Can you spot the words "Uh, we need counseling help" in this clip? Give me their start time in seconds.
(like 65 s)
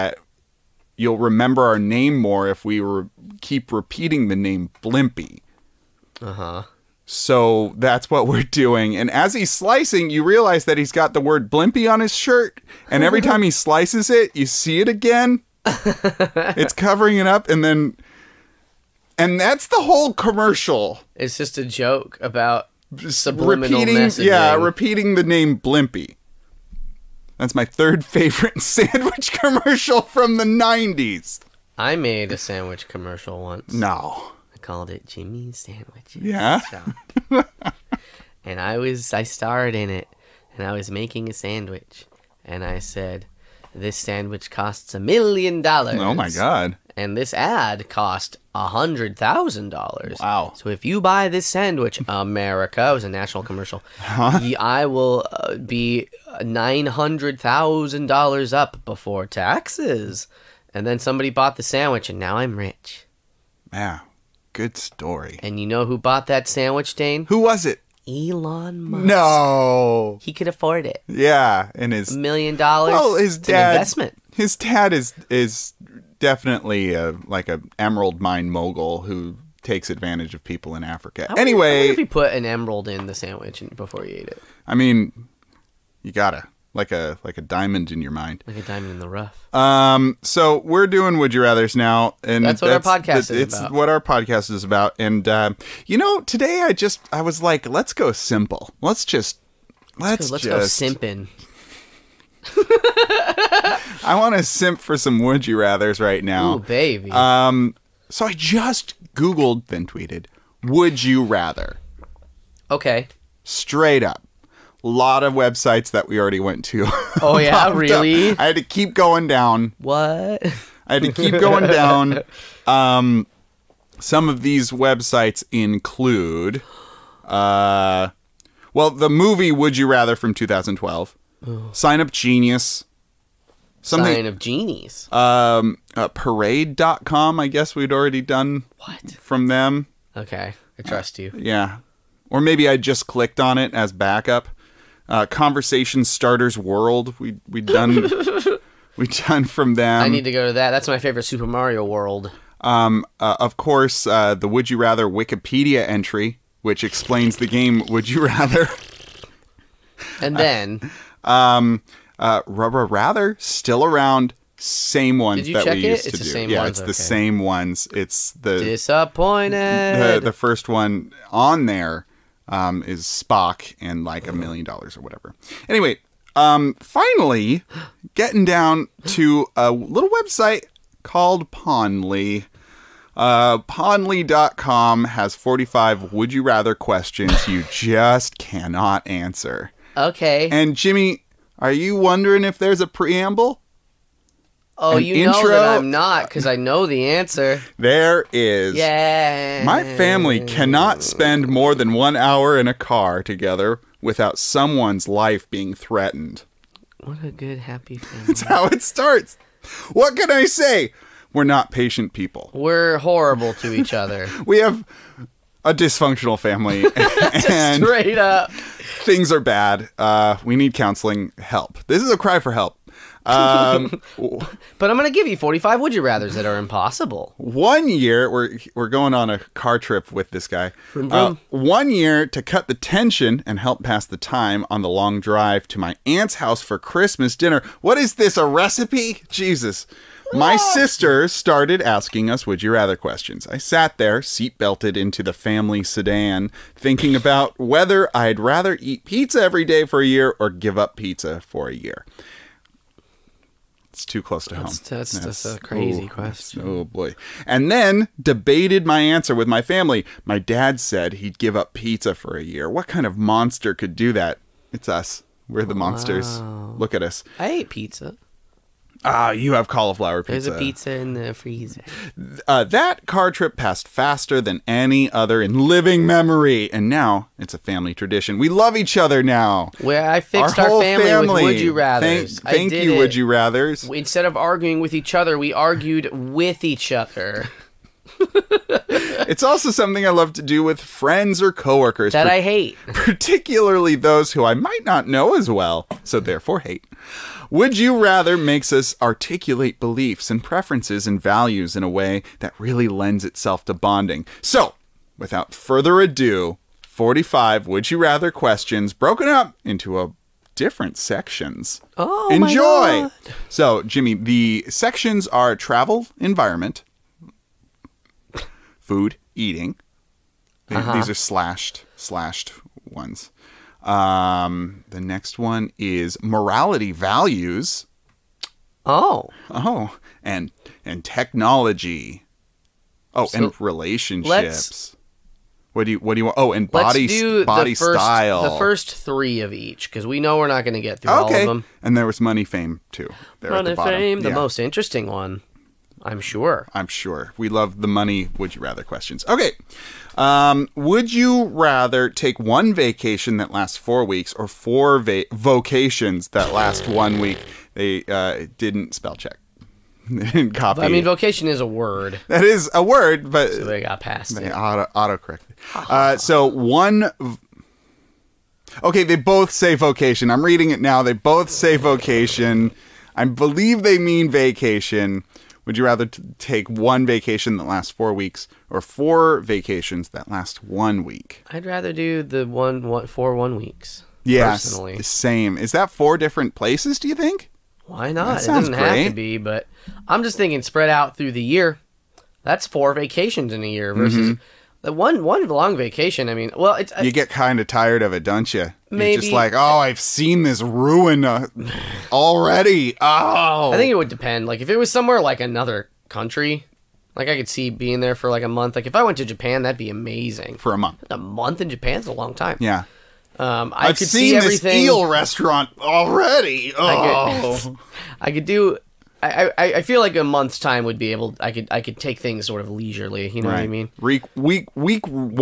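219 s.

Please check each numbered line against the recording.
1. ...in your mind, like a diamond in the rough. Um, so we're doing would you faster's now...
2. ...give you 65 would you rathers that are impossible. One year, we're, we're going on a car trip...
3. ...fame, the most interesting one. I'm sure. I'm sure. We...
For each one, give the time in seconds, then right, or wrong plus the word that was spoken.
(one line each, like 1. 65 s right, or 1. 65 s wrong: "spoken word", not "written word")
1. 87 s wrong: "rather", not "faster"
2. 225 s wrong: "45", not "65"
3. 343 s right.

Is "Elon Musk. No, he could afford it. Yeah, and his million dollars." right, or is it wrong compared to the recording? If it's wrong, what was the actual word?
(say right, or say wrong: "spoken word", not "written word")
right.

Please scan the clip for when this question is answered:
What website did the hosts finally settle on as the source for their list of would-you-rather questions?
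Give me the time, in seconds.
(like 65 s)
183 s.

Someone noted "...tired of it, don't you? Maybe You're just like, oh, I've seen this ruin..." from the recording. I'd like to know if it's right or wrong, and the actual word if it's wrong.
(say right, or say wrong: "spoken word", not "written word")
right.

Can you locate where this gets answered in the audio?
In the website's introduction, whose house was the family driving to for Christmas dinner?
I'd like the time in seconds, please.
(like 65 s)
236 s.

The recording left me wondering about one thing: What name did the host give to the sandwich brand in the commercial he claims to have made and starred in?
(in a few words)
Jimmy's Sandwiches.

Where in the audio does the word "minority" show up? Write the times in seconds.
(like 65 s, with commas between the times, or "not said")
not said.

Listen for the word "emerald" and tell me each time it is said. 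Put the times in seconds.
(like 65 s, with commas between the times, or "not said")
77 s, 82 s.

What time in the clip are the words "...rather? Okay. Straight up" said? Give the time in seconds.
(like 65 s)
111 s.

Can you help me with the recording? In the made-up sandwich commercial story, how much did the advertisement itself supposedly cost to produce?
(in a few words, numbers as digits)
$100,000.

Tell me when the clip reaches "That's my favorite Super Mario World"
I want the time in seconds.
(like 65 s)
150 s.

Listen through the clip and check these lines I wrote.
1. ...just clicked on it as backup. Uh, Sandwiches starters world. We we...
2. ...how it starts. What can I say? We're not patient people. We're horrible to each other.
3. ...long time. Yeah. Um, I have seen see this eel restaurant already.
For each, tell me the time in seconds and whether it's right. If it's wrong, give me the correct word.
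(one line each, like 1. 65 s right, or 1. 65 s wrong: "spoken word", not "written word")
1. 142 s wrong: "Conversation", not "Sandwiches"
2. 208 s right
3. 412 s right.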